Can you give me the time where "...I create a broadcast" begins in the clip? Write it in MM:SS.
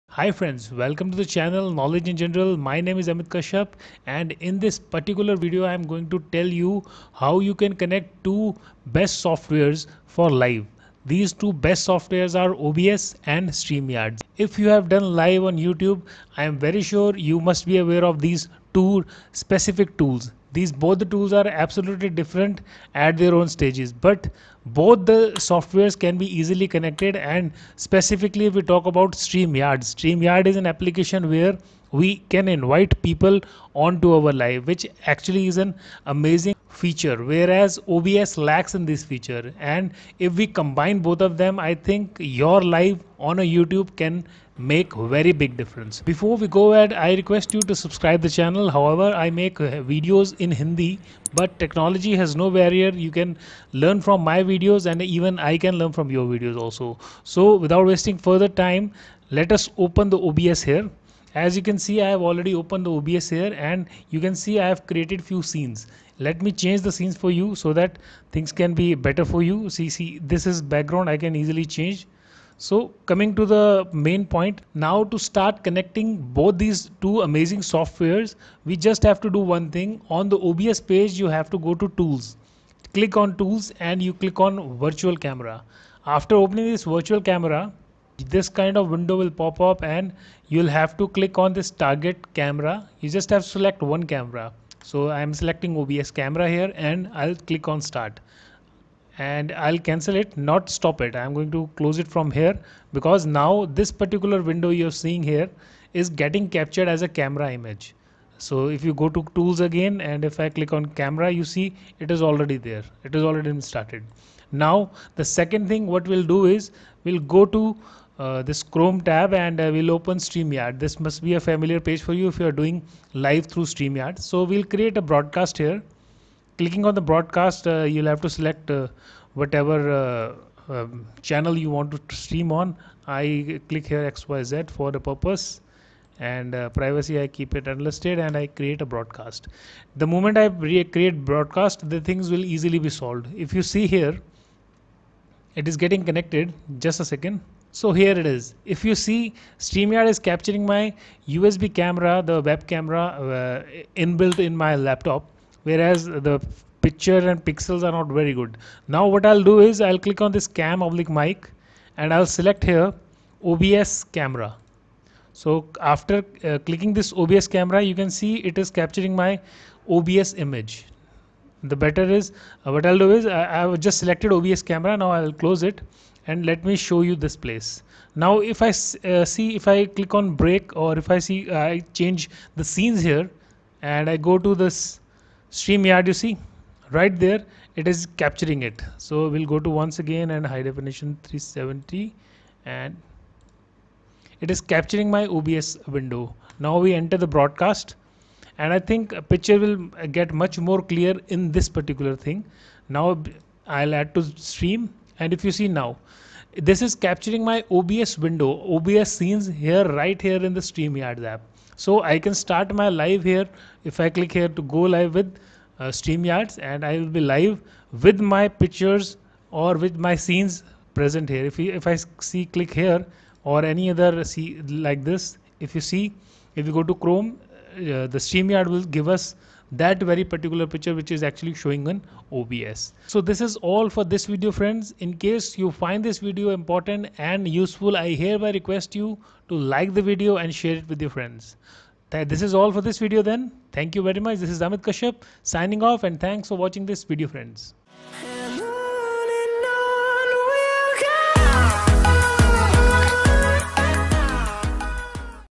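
02:18.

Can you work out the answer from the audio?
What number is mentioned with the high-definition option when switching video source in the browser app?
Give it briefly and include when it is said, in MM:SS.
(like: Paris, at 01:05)
370, at 03:11.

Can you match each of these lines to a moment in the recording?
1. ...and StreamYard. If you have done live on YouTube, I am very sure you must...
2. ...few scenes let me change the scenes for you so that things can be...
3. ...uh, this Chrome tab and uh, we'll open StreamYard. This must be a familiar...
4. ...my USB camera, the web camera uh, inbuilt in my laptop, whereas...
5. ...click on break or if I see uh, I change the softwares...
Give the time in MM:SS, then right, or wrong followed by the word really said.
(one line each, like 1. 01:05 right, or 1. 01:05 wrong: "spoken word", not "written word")
1. 00:13 right
2. 01:05 right
3. 01:58 right
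4. 02:30 right
5. 02:59 wrong: "scenes", not "softwares".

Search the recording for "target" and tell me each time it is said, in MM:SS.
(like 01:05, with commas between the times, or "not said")
01:31.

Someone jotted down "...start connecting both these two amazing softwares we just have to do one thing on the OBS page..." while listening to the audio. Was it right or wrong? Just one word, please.
right.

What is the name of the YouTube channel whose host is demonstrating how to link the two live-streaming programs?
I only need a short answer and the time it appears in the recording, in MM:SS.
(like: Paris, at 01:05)
Knowledge in General, at 00:01.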